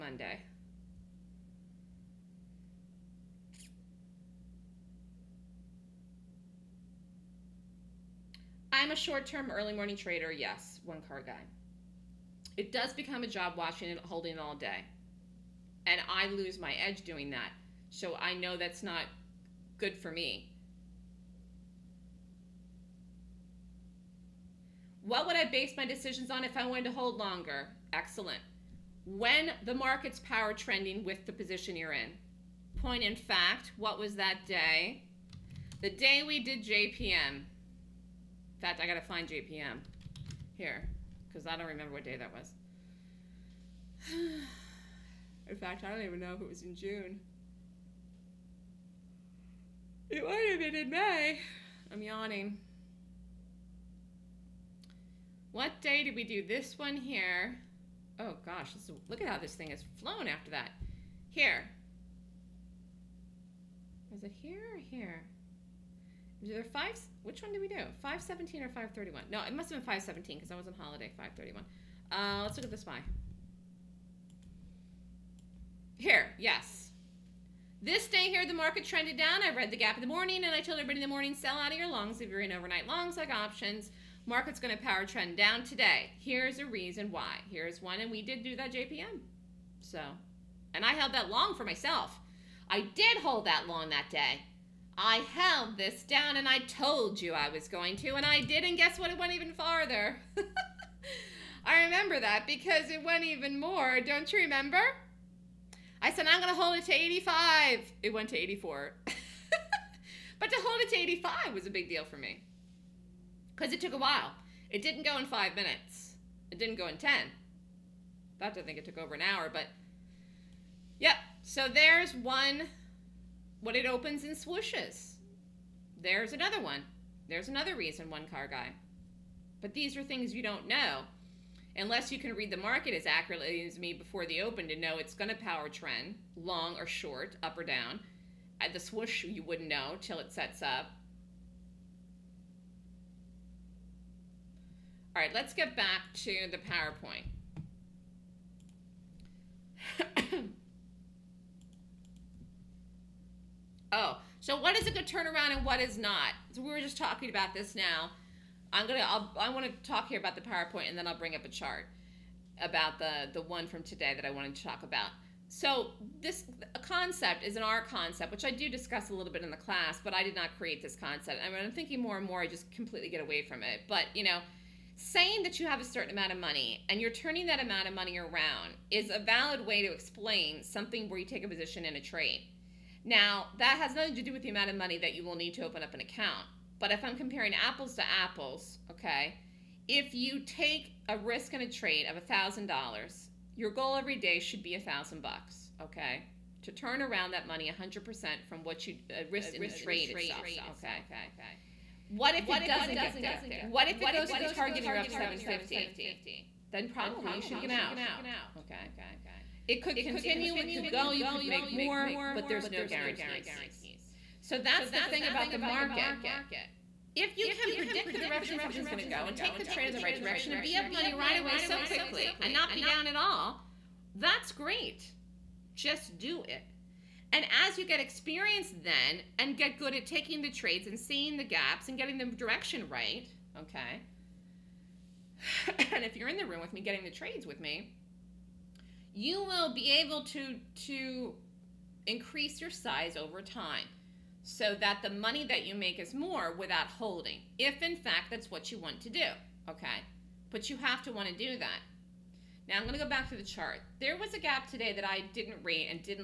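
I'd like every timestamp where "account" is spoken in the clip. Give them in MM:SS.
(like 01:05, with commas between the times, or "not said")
03:06.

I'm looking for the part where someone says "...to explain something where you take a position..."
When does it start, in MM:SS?
02:59.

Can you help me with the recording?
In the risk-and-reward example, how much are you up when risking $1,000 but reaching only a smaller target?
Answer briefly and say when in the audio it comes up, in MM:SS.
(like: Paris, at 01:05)
750, at 03:25.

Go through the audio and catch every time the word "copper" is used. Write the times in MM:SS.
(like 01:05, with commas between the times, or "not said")
not said.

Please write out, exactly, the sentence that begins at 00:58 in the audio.
Oh gosh, is, look at how this thing has flown after that.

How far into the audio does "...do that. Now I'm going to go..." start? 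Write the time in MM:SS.
04:11.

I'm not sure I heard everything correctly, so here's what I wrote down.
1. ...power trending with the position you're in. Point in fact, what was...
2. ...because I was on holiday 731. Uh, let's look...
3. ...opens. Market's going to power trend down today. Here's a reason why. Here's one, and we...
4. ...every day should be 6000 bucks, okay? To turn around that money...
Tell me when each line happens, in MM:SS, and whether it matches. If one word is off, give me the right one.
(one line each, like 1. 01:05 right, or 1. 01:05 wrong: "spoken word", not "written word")
1. 00:30 right
2. 01:10 wrong: "531", not "731"
3. 01:23 wrong: "options", not "opens"
4. 03:13 wrong: "1000", not "6000".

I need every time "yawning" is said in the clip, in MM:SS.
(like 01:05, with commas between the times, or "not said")
00:52.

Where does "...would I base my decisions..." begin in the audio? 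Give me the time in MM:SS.
00:25.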